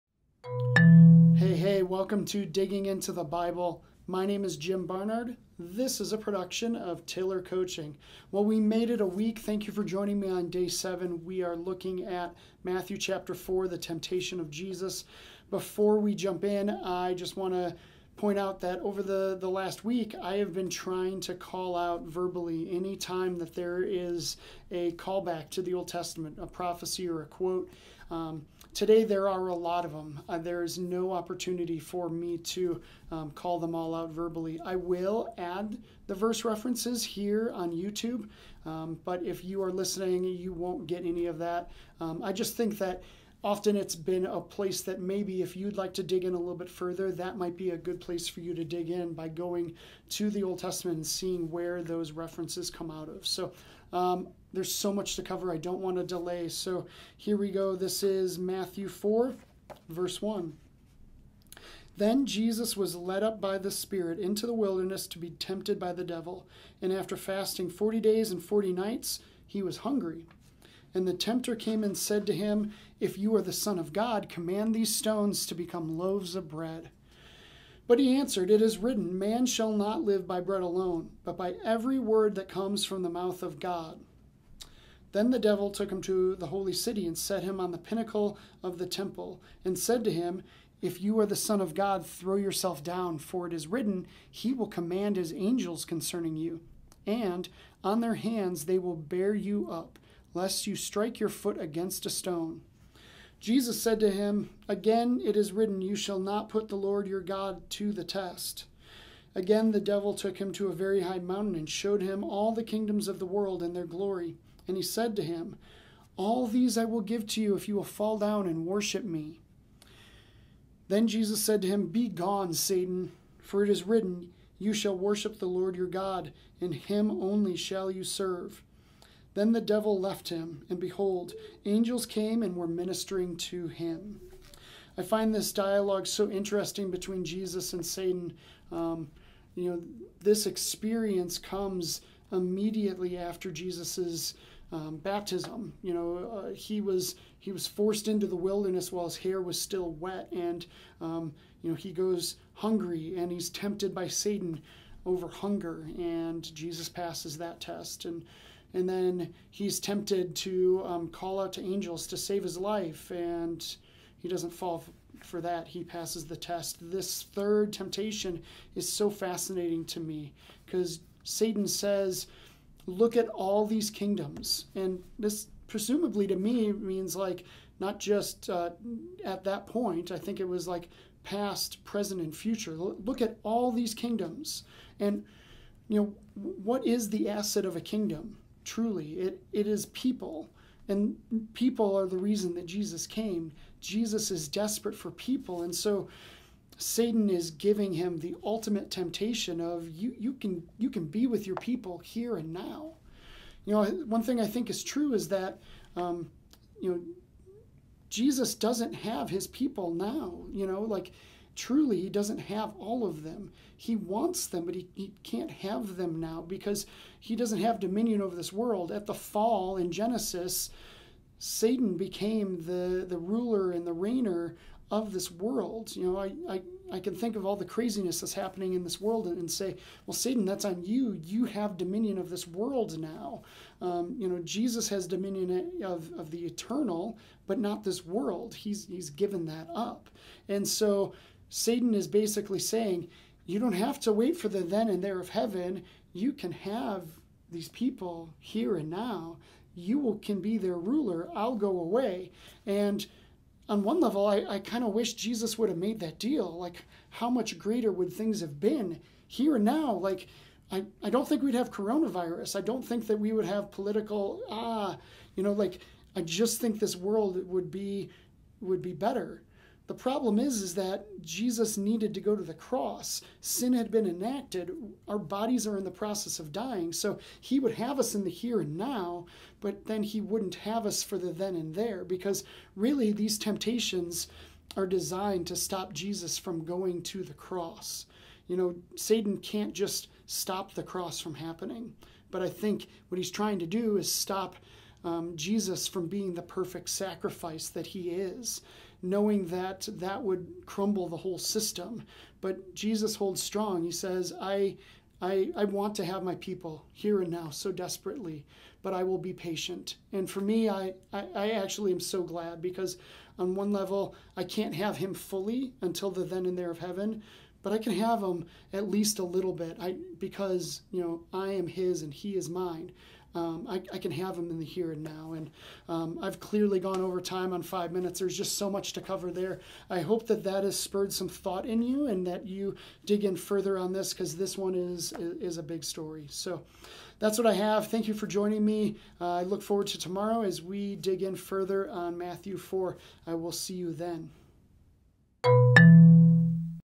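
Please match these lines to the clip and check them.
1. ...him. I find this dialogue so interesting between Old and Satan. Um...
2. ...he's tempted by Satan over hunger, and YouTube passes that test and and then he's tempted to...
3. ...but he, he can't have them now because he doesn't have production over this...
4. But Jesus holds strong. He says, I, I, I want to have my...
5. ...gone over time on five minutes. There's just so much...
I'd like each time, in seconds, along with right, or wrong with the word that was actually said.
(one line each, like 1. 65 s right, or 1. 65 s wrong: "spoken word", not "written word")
1. 133 s wrong: "Jesus", not "Old"
2. 153 s wrong: "Jesus", not "YouTube"
3. 214 s wrong: "dominion", not "production"
4. 302 s right
5. 326 s right.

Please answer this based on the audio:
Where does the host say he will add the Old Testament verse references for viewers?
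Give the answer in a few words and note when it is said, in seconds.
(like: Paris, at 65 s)
YouTube, at 37 s.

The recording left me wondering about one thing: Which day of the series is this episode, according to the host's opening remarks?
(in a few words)
7.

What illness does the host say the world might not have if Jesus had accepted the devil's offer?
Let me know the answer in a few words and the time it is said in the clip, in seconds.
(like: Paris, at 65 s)
coronavirus, at 261 s.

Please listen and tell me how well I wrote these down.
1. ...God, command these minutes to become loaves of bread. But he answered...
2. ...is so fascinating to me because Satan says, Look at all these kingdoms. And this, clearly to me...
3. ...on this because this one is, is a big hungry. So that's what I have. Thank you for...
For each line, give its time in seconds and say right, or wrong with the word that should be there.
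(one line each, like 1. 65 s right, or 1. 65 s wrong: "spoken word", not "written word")
1. 73 s wrong: "stones", not "minutes"
2. 168 s wrong: "presumably", not "clearly"
3. 333 s wrong: "story", not "hungry".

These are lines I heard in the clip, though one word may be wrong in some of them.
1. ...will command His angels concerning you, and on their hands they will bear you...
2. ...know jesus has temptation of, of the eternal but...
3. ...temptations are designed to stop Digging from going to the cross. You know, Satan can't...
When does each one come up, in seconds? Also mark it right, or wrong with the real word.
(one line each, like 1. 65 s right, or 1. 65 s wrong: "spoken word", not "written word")
1. 94 s right
2. 234 s wrong: "dominion", not "temptation"
3. 283 s wrong: "Jesus", not "Digging".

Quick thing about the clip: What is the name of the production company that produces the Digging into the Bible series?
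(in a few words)
Tiller Coaching.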